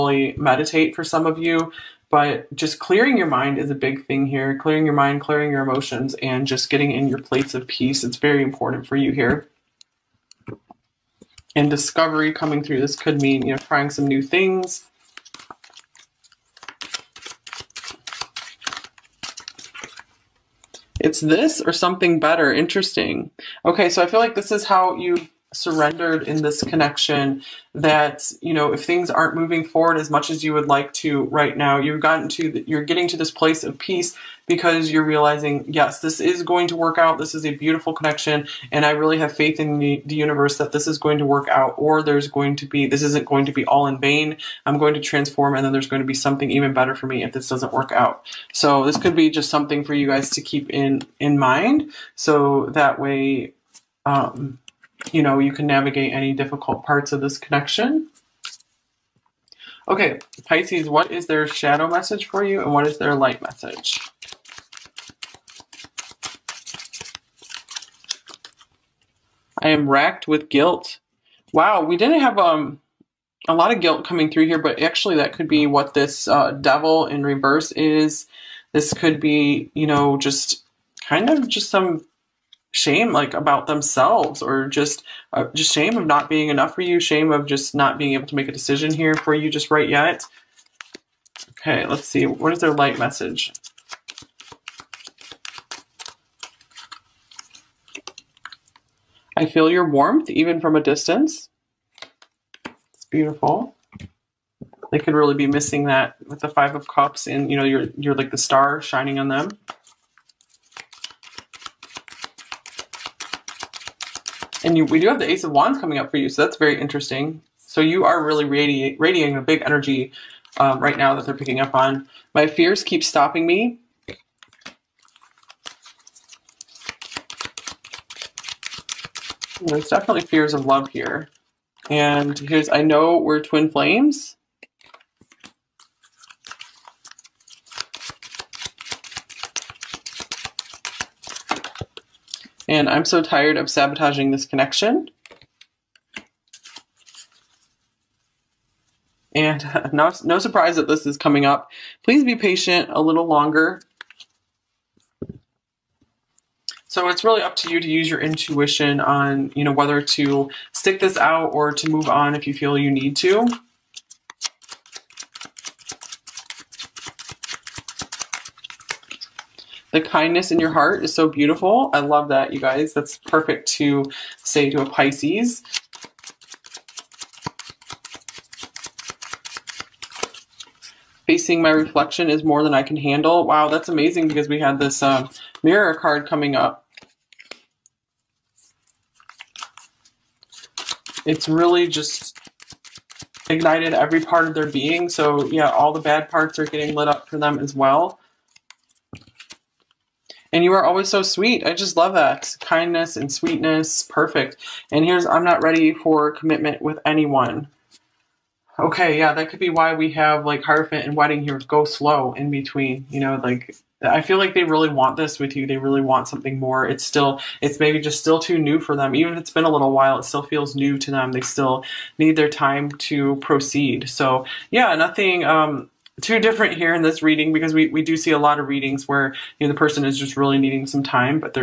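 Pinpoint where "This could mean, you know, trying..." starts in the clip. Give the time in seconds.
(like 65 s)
12 s.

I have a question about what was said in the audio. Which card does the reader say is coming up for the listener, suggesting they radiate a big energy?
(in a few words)
Ace of Wands.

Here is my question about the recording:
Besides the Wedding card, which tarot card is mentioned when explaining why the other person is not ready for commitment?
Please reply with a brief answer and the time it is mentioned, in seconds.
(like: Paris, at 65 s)
Hierophant, at 210 s.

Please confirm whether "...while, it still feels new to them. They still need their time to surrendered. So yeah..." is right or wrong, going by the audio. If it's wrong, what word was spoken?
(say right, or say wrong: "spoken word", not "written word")
wrong: "proceed", not "surrendered".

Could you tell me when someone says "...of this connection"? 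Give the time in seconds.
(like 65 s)
57 s.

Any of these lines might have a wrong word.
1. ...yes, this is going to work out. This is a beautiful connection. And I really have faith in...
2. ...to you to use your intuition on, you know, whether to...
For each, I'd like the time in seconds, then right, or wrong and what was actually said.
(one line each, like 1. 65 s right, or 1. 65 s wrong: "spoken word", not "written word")
1. 35 s right
2. 157 s right.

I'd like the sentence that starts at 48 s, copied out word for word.
So this could be just something for you guys to keep in, in mind.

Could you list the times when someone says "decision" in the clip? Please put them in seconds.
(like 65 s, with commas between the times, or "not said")
88 s.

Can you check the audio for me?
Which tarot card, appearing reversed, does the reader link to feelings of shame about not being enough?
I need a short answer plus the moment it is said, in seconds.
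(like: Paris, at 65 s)
Devil, at 76 s.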